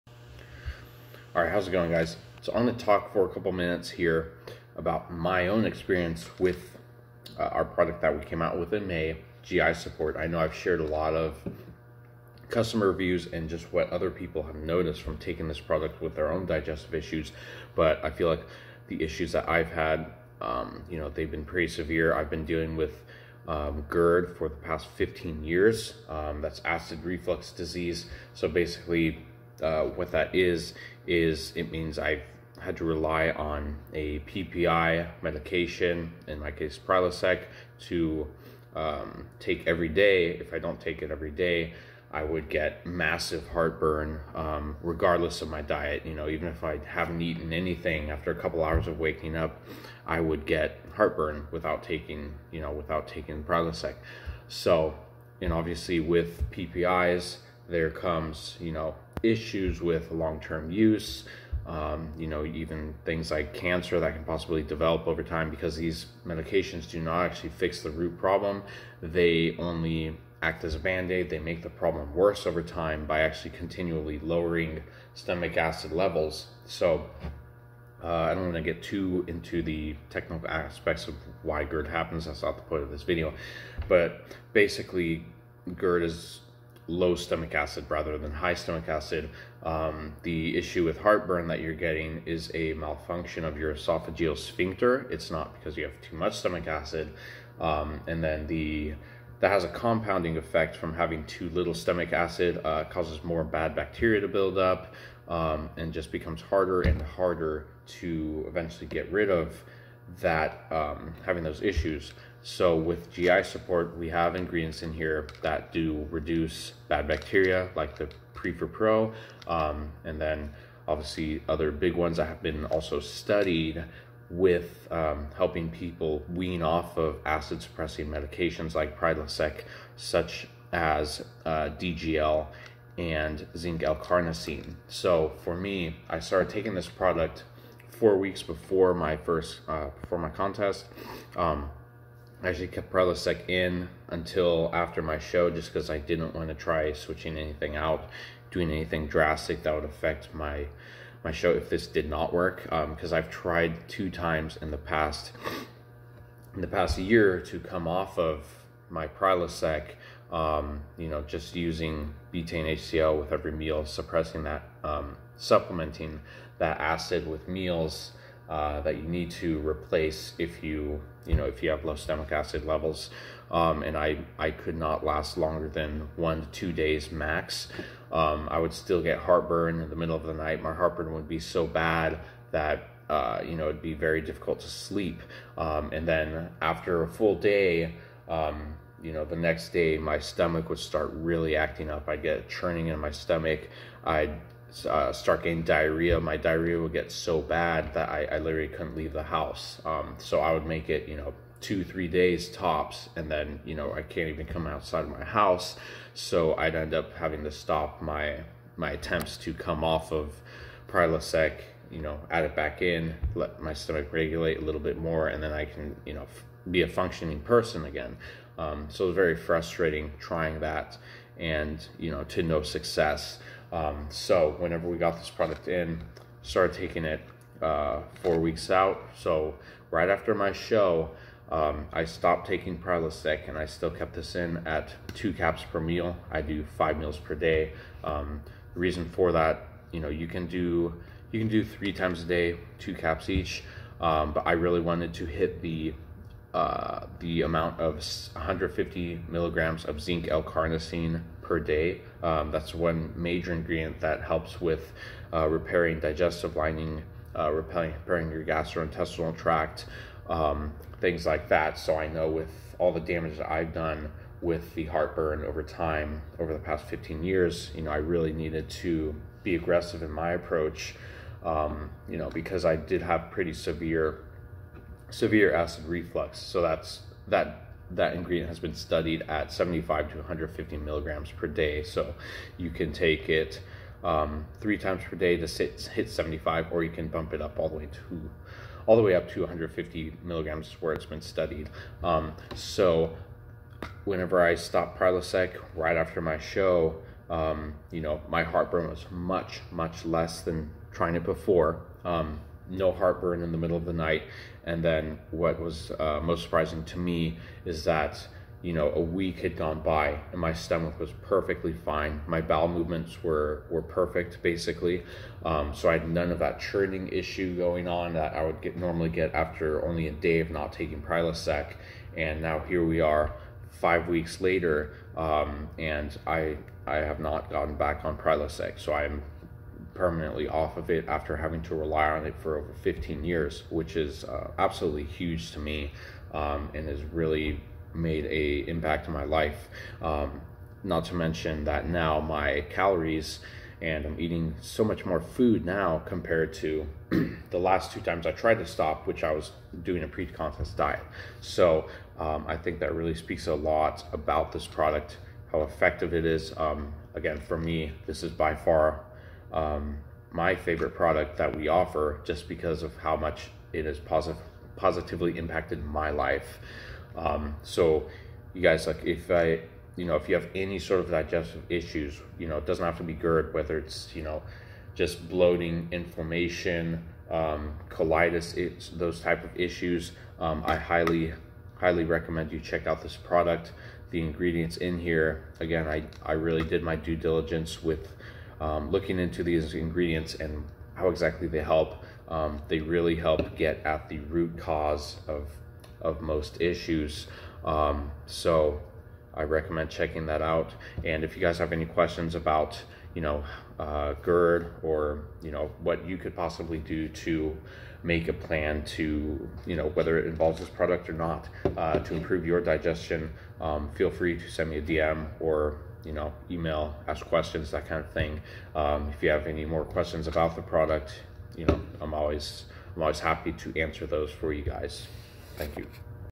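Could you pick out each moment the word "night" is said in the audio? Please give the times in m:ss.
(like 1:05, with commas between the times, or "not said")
3:00, 5:03.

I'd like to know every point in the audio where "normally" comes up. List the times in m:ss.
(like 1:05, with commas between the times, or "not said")
5:18.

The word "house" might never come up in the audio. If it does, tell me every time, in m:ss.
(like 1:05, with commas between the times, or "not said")
3:19, 3:25.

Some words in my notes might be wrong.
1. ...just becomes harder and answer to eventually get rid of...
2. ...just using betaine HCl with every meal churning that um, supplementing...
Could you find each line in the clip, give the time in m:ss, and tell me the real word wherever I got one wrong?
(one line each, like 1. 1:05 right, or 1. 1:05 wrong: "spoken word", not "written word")
1. 1:45 wrong: "harder", not "answer"
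2. 2:41 wrong: "suppressing", not "churning".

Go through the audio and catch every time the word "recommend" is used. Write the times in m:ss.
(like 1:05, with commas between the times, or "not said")
6:22, 6:39.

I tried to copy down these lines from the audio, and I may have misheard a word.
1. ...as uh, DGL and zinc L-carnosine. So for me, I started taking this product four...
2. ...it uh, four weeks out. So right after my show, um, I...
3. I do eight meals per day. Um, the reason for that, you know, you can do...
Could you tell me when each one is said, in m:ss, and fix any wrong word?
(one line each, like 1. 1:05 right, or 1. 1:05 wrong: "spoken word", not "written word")
1. 2:10 right
2. 3:47 right
3. 3:56 wrong: "five", not "eight".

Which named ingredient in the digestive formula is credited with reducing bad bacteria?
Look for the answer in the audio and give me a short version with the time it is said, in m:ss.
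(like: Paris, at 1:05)
PreforPro, at 1:58.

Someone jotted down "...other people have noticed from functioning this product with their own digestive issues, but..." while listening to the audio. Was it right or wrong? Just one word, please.
wrong.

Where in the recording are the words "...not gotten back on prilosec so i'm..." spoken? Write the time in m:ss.
5:27.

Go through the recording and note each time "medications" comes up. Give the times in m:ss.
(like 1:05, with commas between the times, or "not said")
0:35, 1:06, 2:08.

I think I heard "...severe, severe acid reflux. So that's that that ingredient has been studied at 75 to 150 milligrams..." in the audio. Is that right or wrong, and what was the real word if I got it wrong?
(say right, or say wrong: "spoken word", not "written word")
right.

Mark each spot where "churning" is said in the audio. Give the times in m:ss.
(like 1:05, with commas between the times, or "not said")
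3:12, 5:16.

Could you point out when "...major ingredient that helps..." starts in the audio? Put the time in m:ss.
4:13.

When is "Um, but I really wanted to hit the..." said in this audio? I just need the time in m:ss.
4:04.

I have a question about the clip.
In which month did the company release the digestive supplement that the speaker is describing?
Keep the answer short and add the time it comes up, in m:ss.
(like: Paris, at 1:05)
May, at 0:08.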